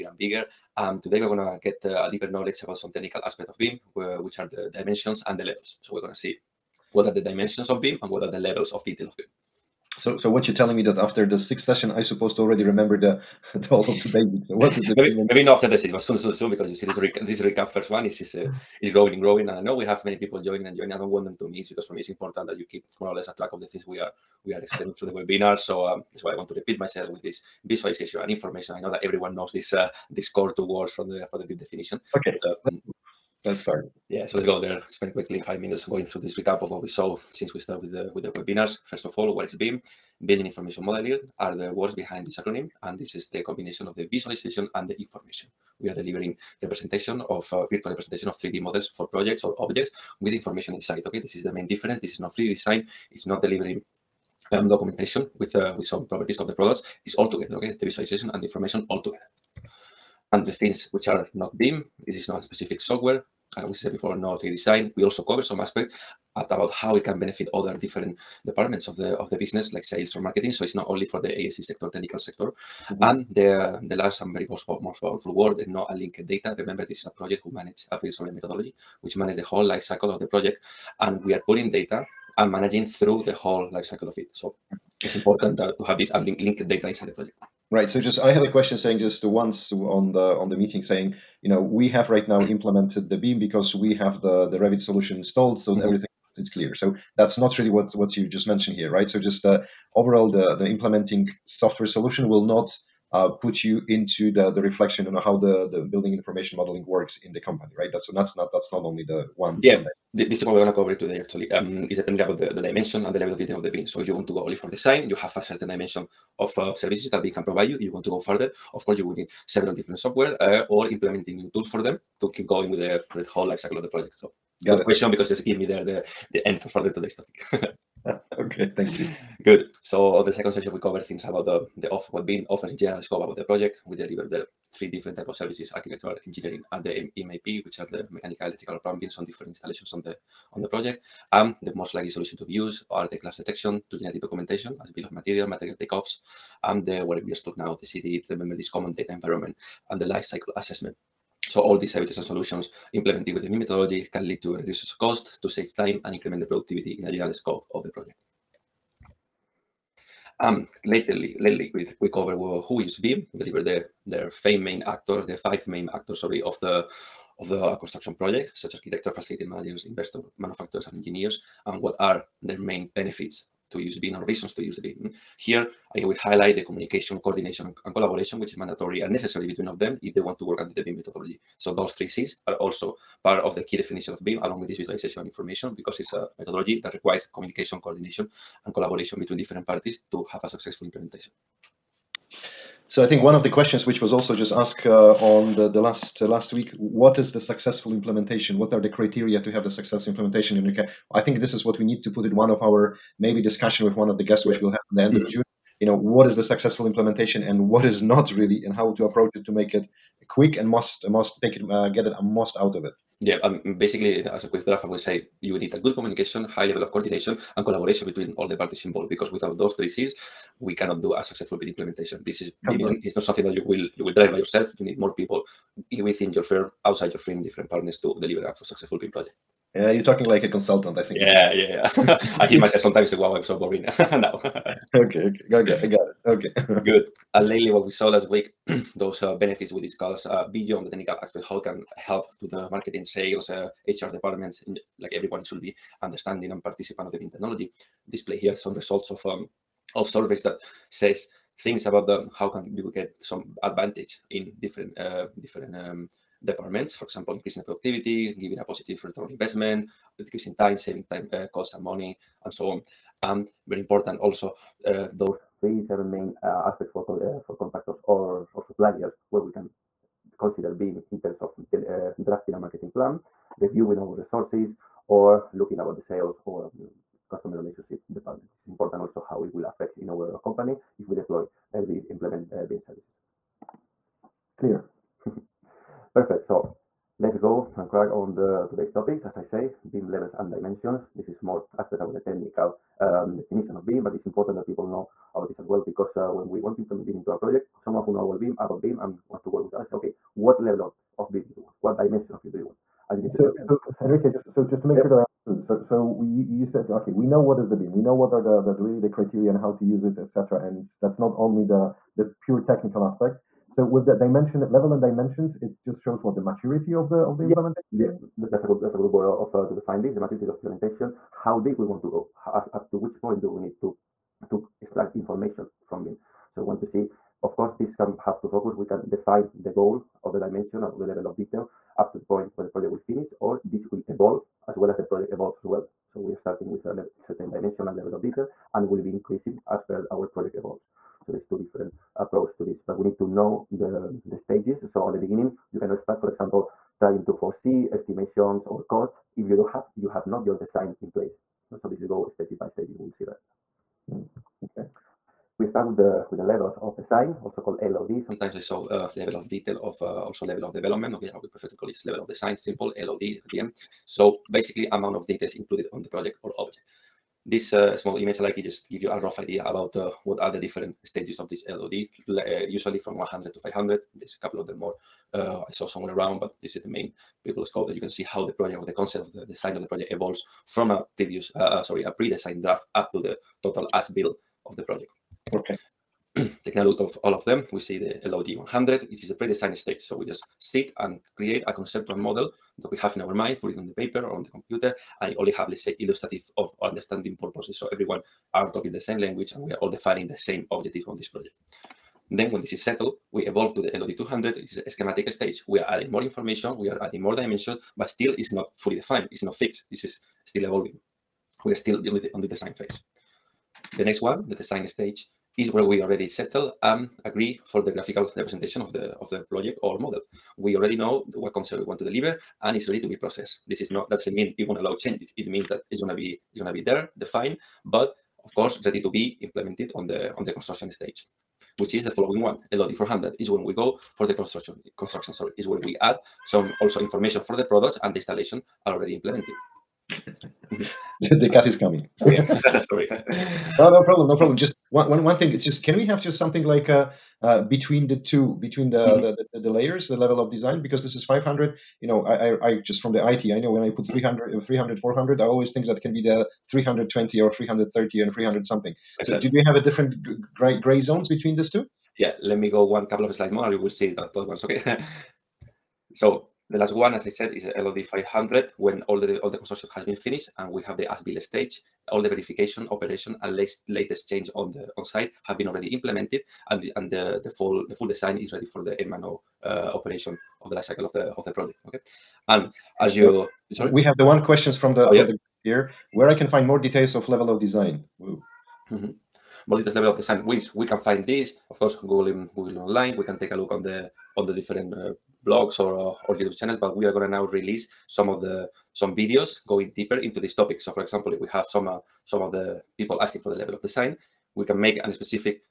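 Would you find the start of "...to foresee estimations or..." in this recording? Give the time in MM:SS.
05:47.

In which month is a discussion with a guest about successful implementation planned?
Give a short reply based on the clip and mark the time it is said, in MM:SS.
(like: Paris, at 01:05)
June, at 03:25.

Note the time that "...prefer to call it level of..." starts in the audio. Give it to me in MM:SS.
06:01.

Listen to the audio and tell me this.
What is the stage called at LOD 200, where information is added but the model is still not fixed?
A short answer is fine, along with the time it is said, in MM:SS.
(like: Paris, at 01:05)
schematic stage, at 06:44.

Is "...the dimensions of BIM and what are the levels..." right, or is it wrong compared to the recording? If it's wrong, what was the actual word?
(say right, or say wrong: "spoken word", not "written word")
right.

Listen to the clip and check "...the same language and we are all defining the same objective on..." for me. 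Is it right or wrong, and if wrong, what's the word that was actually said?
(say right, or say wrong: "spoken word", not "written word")
right.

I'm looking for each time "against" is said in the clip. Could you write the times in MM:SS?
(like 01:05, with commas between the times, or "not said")
not said.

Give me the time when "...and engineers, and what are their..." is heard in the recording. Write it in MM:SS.
02:50.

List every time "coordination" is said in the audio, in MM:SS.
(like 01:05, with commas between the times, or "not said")
02:57, 03:07, 03:36.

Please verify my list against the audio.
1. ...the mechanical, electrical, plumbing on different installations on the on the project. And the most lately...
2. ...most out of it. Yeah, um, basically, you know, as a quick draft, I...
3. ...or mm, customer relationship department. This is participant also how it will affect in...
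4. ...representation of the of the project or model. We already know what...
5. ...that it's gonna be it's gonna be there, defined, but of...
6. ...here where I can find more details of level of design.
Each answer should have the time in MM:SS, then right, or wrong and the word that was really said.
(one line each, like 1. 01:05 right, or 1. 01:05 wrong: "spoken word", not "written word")
1. 02:17 wrong: "likely", not "lately"
2. 03:32 right
3. 04:36 wrong: "important", not "participant"
4. 06:58 right
5. 07:05 right
6. 08:05 right.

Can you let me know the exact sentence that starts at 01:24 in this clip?
So it's important to have this linked data inside the project.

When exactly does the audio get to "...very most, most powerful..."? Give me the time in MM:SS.
01:14.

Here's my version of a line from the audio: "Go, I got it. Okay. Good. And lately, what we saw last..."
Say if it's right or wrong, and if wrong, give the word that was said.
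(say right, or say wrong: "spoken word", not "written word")
right.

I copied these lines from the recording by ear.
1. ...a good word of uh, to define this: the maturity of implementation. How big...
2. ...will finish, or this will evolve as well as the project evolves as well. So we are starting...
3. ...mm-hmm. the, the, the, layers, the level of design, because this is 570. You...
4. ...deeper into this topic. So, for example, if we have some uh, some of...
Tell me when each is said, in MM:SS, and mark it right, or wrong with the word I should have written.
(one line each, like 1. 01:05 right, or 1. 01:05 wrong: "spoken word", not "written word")
1. 05:18 right
2. 05:32 right
3. 07:29 wrong: "500", not "570"
4. 08:19 right.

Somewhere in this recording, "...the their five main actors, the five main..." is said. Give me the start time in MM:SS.
02:43.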